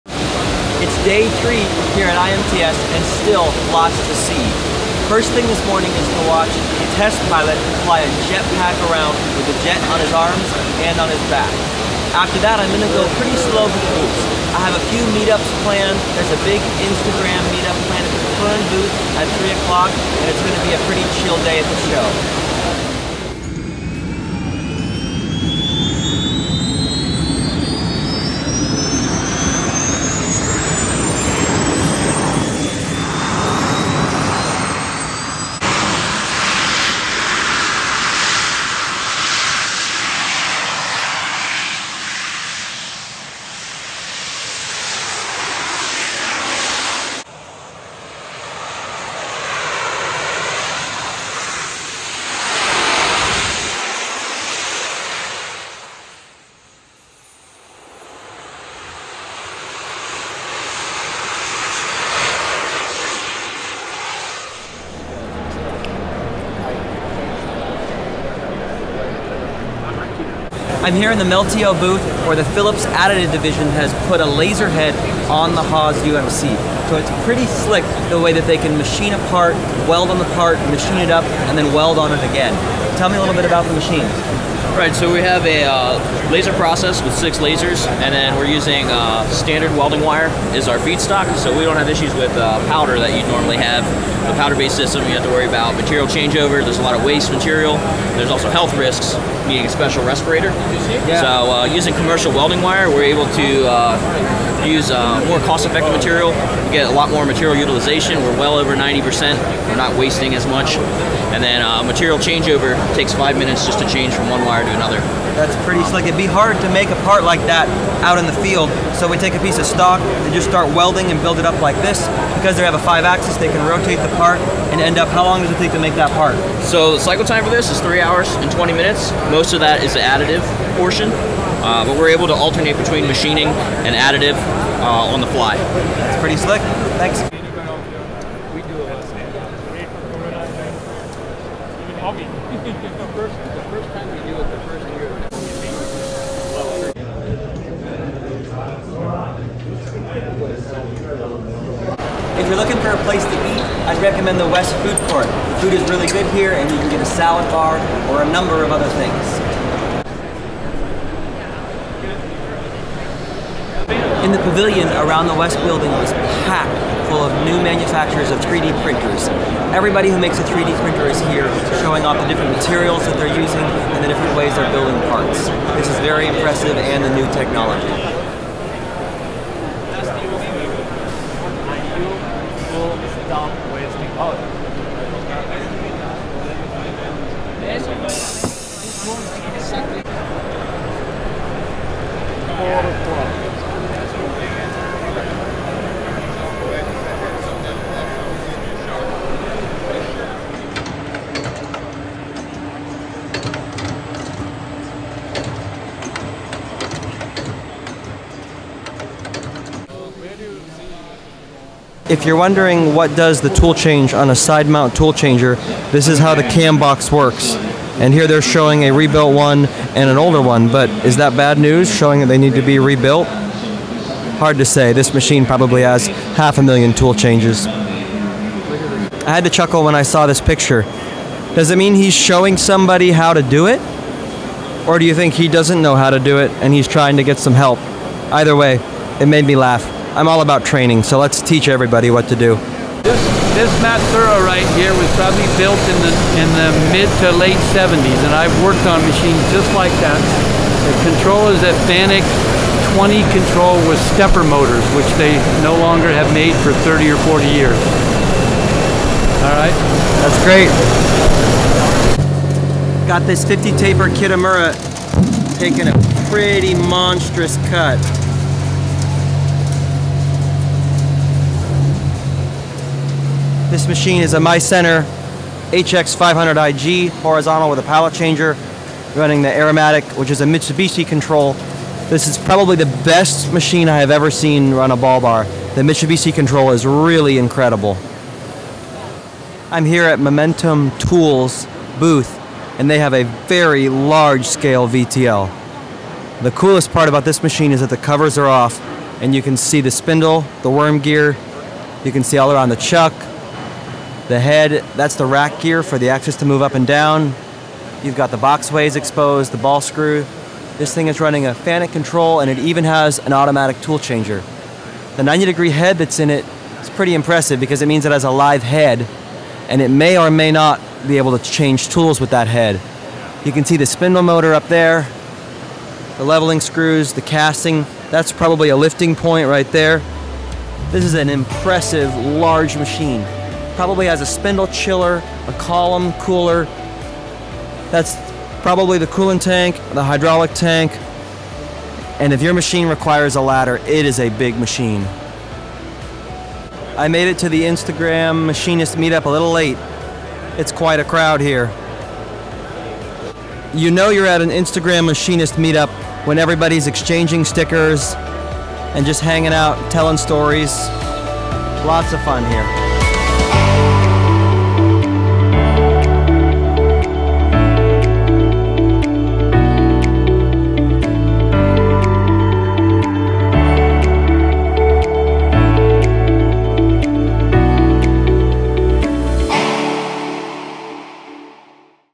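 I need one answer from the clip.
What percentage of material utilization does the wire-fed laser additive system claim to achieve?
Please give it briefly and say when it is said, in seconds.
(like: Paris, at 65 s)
over 90%, at 108 s.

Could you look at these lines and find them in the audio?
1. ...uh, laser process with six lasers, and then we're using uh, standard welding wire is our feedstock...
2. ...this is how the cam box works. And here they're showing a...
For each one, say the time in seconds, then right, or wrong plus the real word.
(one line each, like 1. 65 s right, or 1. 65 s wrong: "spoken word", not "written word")
1. 85 s right
2. 215 s right.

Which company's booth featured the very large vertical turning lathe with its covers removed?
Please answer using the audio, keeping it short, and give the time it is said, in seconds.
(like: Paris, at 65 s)
Momentum Tools, at 290 s.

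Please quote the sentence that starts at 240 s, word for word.
I'm all about training, so let's teach everybody what to do.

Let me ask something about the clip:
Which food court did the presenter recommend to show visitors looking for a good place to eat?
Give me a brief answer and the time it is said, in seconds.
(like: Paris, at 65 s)
West Food Court, at 154 s.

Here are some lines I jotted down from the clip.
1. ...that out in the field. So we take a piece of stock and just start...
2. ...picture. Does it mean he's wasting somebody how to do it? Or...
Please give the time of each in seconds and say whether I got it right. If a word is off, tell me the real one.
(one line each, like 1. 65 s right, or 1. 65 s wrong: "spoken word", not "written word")
1. 117 s right
2. 230 s wrong: "showing", not "wasting".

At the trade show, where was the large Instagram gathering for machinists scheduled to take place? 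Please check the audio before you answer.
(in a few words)
Kern booth.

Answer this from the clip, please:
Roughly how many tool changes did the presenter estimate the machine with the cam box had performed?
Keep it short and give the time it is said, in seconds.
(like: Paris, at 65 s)
half a million, at 226 s.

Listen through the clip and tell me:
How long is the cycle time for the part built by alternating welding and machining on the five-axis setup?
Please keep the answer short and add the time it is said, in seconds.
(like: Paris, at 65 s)
3 hours 20 minutes, at 127 s.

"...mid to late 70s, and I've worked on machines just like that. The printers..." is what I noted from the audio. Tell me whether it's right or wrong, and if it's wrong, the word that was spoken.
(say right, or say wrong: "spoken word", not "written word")
wrong: "controllers", not "printers".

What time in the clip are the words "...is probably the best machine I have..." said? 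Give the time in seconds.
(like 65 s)
282 s.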